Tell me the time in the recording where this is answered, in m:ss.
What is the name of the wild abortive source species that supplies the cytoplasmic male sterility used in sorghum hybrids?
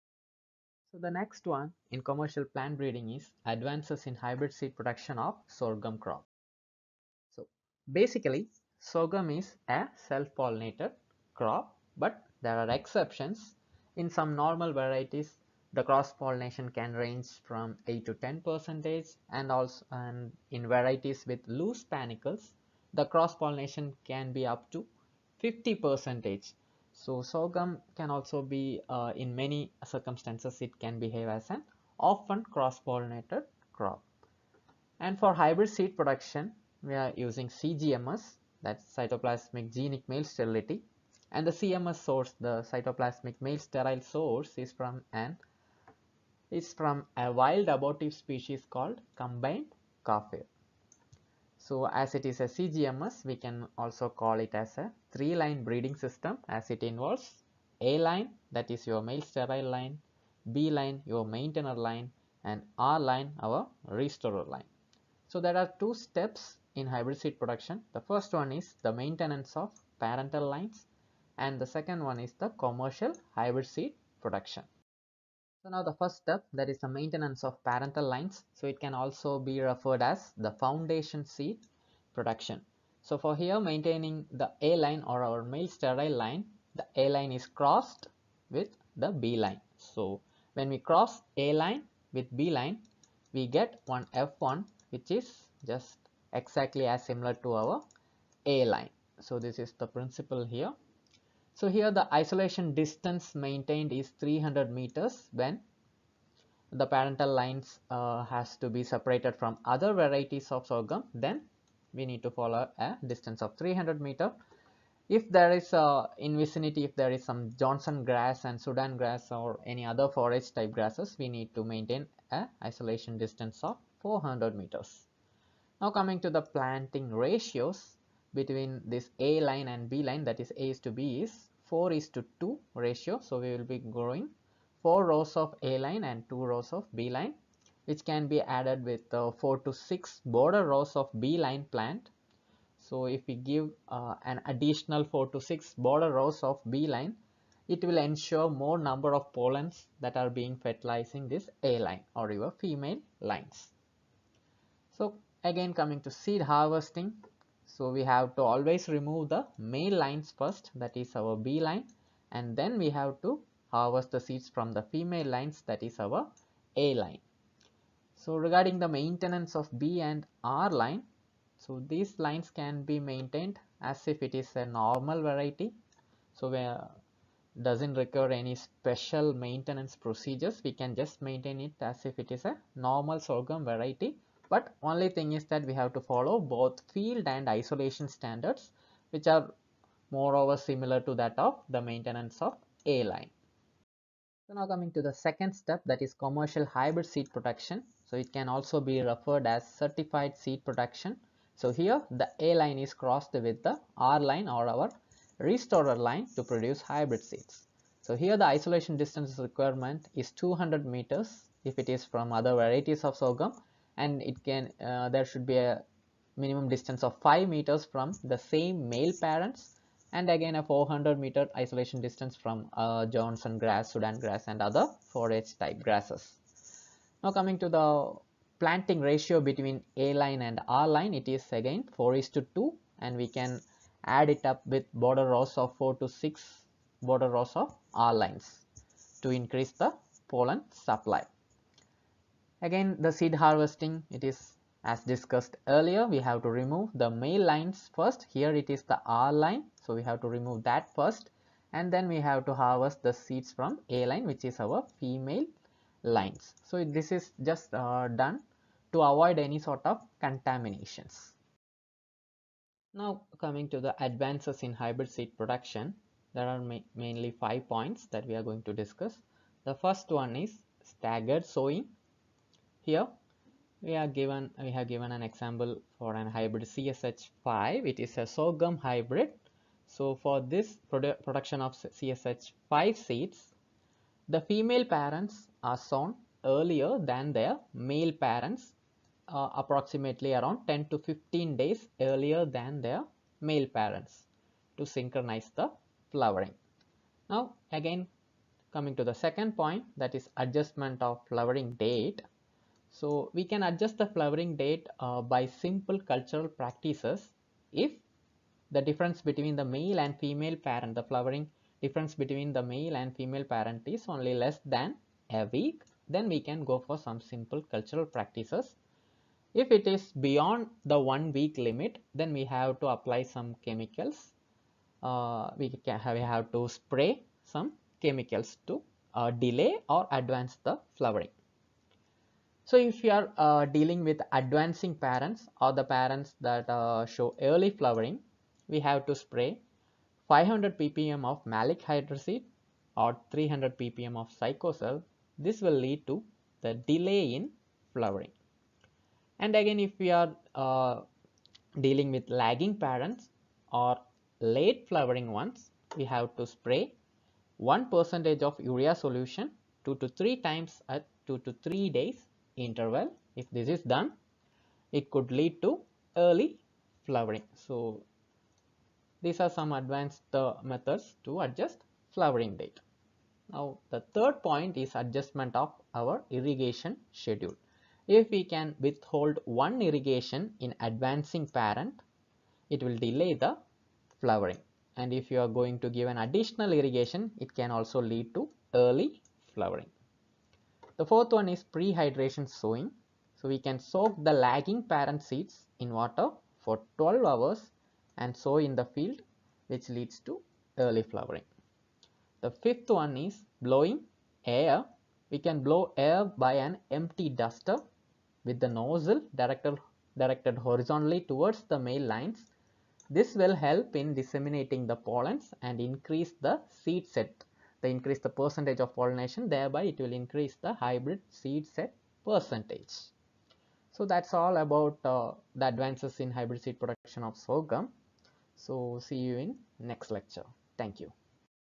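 0:49.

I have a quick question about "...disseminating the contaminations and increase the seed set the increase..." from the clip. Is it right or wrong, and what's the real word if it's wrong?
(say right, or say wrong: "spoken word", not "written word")
wrong: "pollens", not "contaminations".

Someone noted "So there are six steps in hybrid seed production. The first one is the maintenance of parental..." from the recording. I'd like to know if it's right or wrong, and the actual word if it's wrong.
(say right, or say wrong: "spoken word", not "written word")
wrong: "two", not "six".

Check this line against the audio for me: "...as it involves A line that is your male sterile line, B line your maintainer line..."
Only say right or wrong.
right.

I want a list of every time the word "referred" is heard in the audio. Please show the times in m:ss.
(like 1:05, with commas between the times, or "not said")
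1:19, 3:19.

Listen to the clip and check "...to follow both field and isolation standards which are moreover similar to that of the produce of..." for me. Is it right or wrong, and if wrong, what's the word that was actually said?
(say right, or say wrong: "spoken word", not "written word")
wrong: "maintenance", not "produce".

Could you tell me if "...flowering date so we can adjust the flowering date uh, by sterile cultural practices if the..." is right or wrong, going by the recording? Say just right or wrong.
wrong.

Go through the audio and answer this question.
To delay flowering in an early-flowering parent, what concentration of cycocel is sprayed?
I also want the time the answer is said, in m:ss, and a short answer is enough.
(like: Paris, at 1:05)
300 ppm, at 5:43.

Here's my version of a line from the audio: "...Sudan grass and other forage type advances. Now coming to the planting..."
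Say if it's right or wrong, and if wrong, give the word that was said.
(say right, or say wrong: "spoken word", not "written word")
wrong: "grasses", not "advances".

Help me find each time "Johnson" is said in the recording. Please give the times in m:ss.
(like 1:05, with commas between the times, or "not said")
1:57, 3:43.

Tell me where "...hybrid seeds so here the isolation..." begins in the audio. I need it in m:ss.
3:26.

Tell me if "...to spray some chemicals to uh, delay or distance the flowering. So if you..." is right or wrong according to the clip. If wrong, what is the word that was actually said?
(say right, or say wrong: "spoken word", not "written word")
wrong: "advance", not "distance".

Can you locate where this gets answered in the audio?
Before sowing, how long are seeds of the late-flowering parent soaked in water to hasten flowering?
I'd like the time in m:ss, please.
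6:36.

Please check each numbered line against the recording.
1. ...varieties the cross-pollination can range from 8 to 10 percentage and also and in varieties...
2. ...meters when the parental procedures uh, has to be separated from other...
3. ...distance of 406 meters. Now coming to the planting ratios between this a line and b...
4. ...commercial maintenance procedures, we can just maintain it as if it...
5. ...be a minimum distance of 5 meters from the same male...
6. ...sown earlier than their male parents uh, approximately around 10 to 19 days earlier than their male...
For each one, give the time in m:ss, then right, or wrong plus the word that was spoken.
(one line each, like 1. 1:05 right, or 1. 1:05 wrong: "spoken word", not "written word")
1. 0:14 right
2. 1:44 wrong: "lines", not "procedures"
3. 2:03 wrong: "400", not "406"
4. 2:58 wrong: "special", not "commercial"
5. 3:35 right
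6. 4:45 wrong: "15", not "19".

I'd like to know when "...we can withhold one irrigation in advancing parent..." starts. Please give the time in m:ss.
6:18.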